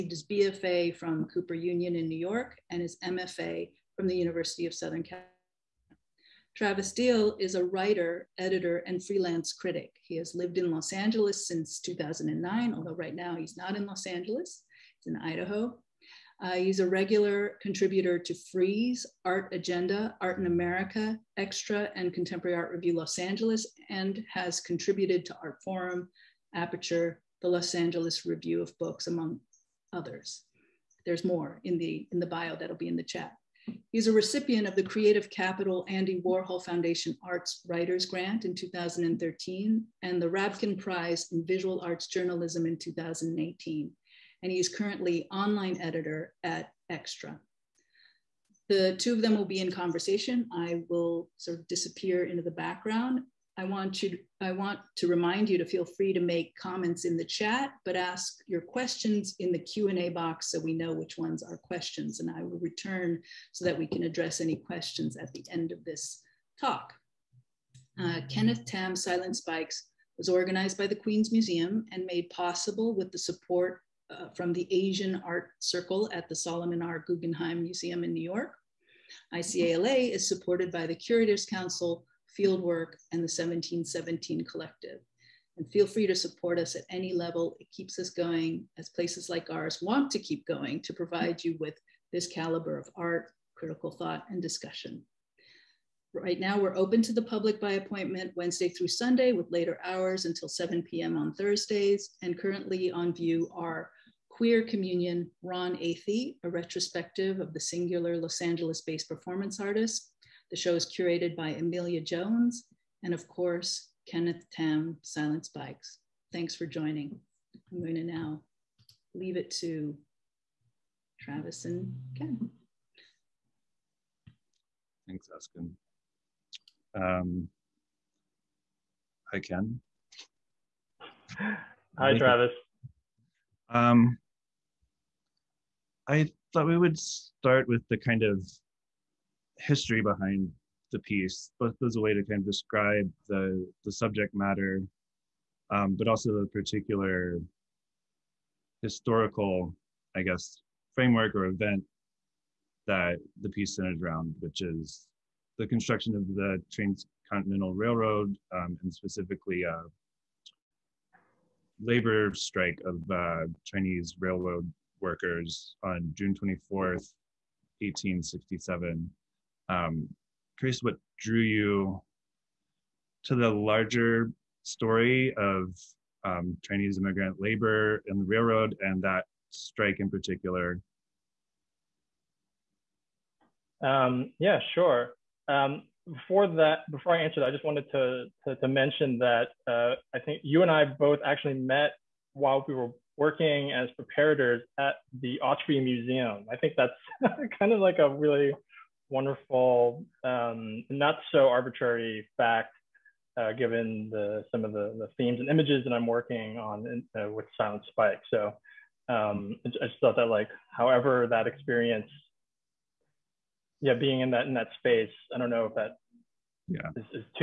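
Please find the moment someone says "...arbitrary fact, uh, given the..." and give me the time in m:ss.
3:21.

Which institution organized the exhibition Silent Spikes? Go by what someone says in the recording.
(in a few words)
Queens Museum.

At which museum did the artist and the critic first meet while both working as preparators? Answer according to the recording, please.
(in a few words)
Autry Museum.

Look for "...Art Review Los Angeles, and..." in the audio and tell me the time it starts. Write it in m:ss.
0:22.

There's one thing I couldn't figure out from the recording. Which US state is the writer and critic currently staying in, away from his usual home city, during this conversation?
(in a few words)
Idaho.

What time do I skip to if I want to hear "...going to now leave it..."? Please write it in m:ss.
1:57.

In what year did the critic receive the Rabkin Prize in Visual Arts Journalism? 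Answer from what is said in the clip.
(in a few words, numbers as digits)
2018.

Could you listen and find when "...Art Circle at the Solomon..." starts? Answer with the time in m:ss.
1:15.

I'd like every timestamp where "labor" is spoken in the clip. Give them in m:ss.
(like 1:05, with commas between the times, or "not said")
2:41, 2:57.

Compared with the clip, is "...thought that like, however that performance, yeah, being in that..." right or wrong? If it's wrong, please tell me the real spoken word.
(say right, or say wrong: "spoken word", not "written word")
wrong: "experience", not "performance".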